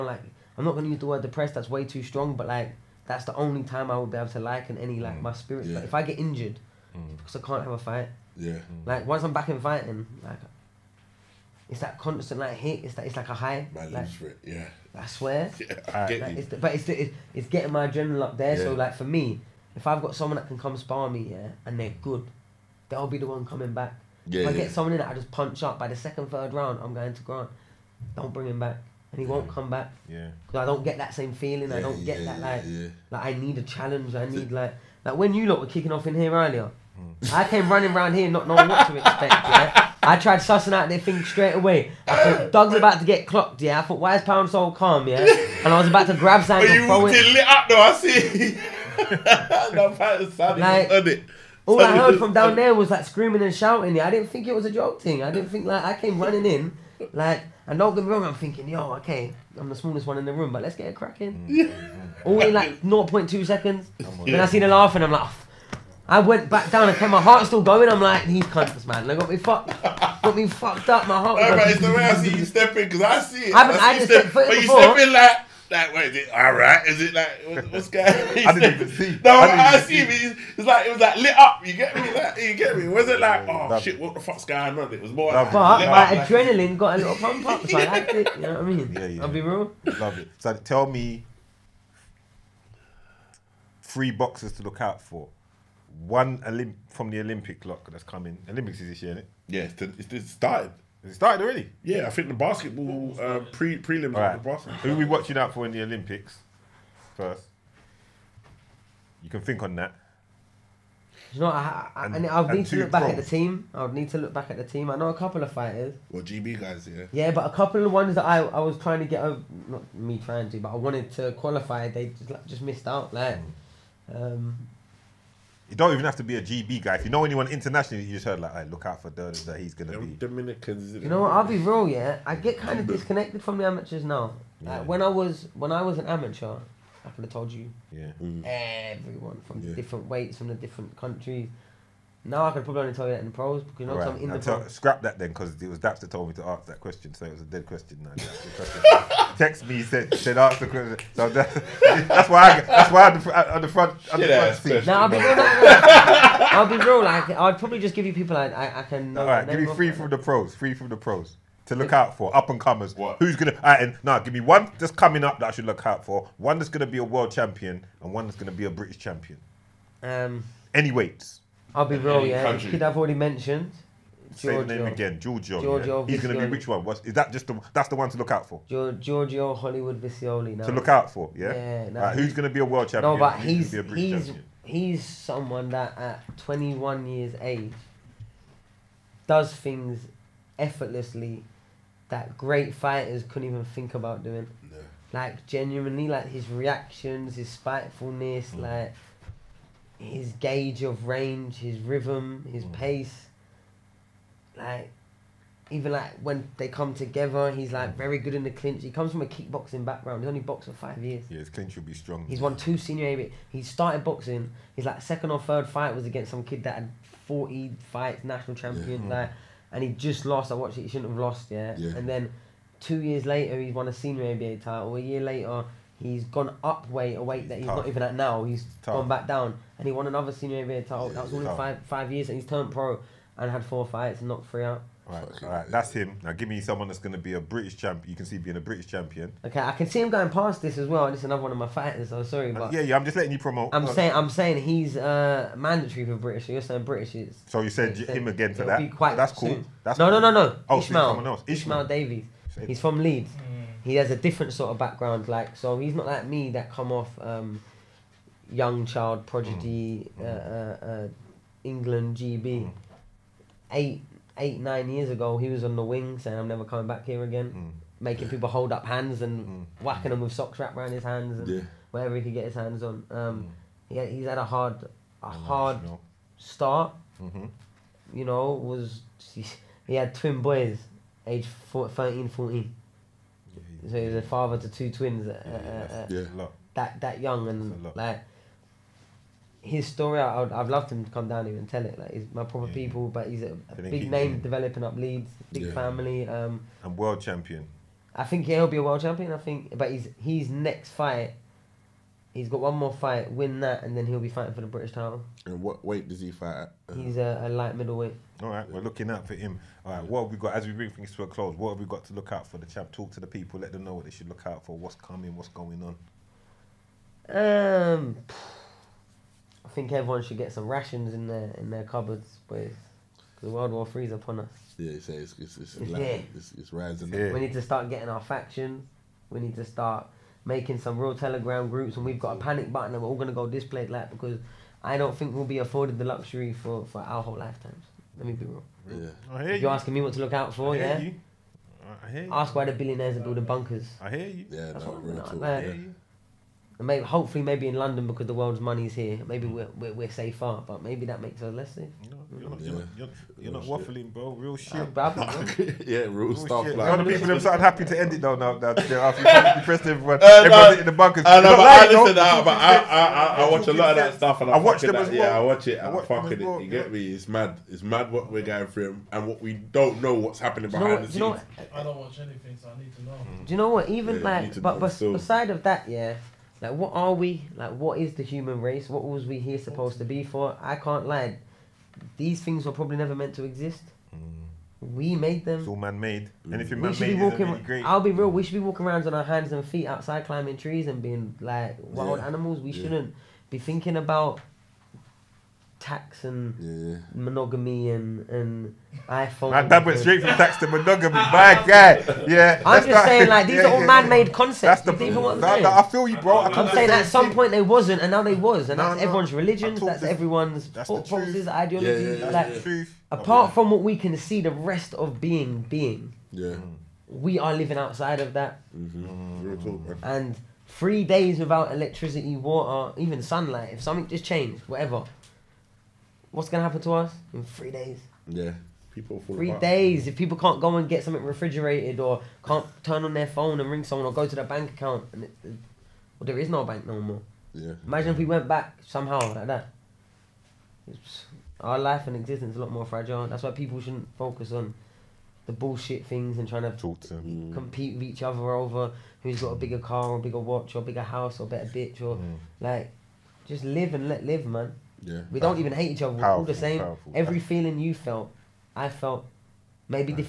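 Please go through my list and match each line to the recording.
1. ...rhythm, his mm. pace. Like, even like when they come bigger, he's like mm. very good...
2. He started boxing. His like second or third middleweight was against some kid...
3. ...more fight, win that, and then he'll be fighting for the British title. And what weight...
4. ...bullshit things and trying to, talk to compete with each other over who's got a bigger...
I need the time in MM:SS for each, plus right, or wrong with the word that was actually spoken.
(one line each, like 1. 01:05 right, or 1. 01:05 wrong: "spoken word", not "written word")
1. 03:21 wrong: "together", not "bigger"
2. 03:33 wrong: "fight", not "middleweight"
3. 05:02 right
4. 07:25 right.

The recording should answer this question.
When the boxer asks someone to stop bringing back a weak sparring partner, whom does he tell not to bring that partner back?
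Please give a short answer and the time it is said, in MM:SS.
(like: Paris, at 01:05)
Grant, at 00:27.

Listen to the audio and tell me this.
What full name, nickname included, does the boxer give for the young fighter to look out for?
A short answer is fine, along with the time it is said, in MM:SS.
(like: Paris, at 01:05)
Giorgio Hollywood Visioli, at 02:58.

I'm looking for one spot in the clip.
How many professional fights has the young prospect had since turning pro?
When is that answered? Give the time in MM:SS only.
03:53.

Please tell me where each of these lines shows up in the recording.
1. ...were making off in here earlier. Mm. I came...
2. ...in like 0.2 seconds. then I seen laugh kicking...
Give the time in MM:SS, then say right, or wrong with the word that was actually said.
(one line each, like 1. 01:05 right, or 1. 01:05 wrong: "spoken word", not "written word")
1. 00:35 wrong: "kicking", not "making"
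2. 01:02 wrong: "laughing", not "kicking".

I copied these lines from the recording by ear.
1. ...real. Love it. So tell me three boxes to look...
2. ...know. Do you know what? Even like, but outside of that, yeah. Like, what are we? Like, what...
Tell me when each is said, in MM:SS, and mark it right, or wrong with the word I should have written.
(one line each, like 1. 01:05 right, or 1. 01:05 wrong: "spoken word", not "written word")
1. 01:29 right
2. 06:13 wrong: "beside", not "outside".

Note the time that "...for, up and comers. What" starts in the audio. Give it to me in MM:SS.
02:42.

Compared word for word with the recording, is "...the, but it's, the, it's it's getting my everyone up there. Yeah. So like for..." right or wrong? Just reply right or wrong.
wrong.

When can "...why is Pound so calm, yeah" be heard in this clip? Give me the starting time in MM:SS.
00:43.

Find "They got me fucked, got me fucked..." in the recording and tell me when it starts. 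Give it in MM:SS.
01:09.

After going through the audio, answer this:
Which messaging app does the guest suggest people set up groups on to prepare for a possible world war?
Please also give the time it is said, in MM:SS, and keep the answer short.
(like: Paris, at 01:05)
Telegram, at 05:31.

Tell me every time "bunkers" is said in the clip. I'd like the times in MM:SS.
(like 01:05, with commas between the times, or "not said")
05:43, 06:00.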